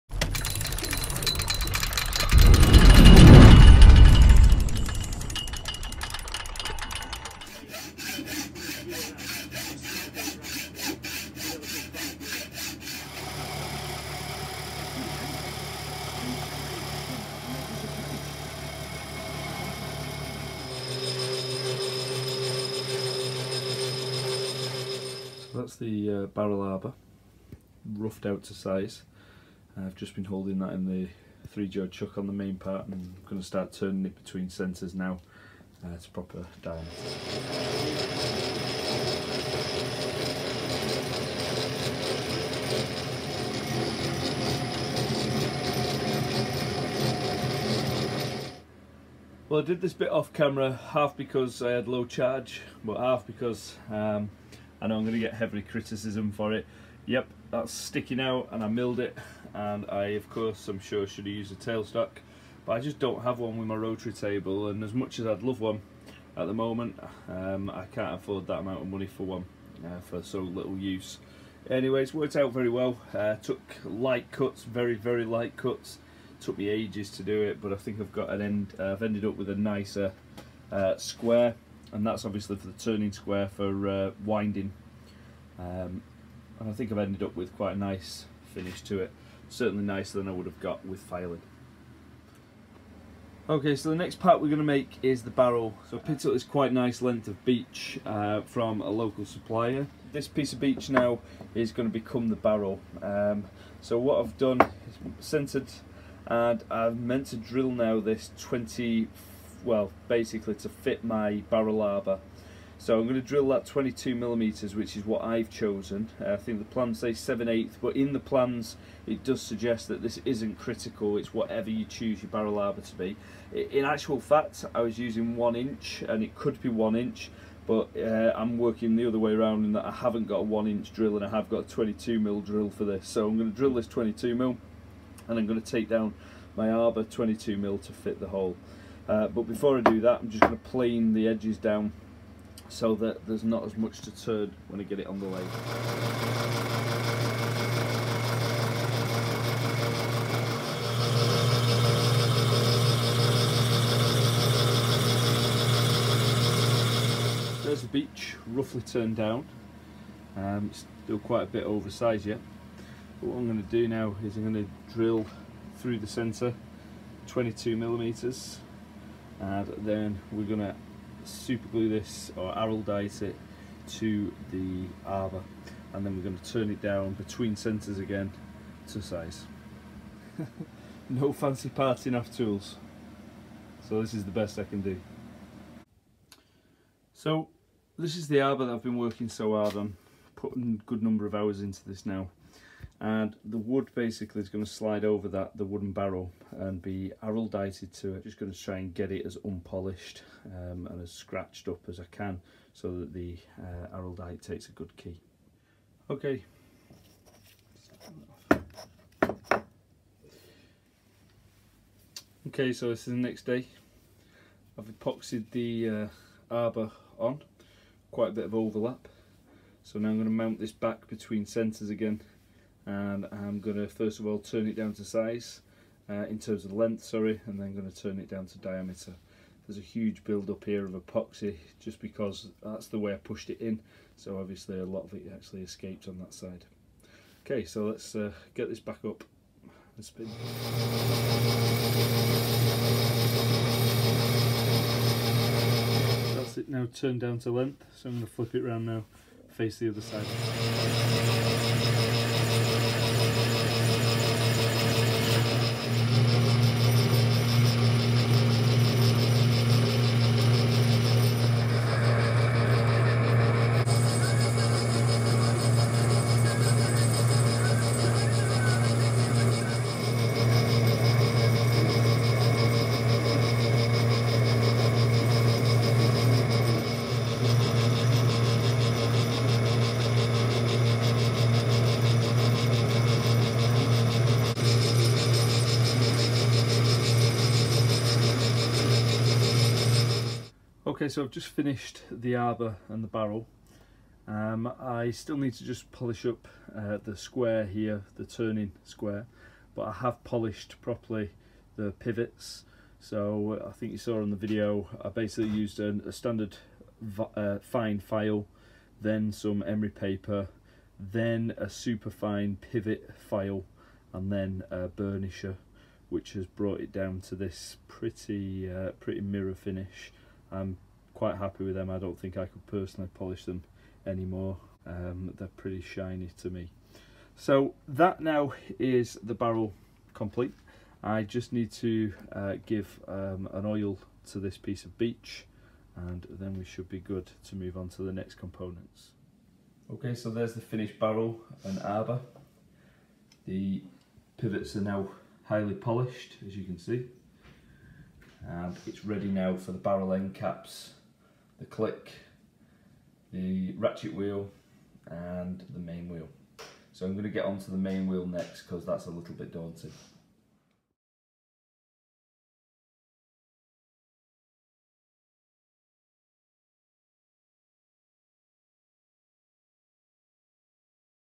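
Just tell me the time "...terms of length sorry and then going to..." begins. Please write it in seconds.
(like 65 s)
226 s.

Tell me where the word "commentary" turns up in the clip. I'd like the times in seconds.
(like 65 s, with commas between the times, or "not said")
not said.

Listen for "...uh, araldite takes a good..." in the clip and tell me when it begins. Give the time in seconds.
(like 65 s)
203 s.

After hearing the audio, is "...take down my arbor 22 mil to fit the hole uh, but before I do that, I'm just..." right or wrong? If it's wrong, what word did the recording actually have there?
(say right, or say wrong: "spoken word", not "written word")
right.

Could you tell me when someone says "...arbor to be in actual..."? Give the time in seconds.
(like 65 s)
122 s.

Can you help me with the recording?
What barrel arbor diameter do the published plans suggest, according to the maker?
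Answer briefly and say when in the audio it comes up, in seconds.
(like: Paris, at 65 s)
7/8, at 117 s.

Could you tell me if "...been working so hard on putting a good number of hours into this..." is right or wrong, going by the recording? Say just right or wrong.
right.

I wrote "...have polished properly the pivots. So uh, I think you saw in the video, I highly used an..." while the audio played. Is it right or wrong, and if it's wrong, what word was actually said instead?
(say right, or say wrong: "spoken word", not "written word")
wrong: "basically", not "highly".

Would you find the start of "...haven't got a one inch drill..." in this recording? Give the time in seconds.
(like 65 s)
129 s.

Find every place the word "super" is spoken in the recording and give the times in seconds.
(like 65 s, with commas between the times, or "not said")
171 s, 311 s.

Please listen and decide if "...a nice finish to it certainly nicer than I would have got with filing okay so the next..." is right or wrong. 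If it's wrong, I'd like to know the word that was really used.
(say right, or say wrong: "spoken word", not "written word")
right.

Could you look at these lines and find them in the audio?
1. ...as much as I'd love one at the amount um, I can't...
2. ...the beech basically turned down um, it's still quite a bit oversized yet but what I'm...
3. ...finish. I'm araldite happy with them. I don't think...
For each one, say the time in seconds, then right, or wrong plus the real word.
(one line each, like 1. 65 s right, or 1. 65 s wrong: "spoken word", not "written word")
1. 64 s wrong: "moment", not "amount"
2. 157 s wrong: "roughly", not "basically"
3. 319 s wrong: "quite", not "araldite".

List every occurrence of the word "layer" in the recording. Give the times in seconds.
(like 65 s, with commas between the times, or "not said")
not said.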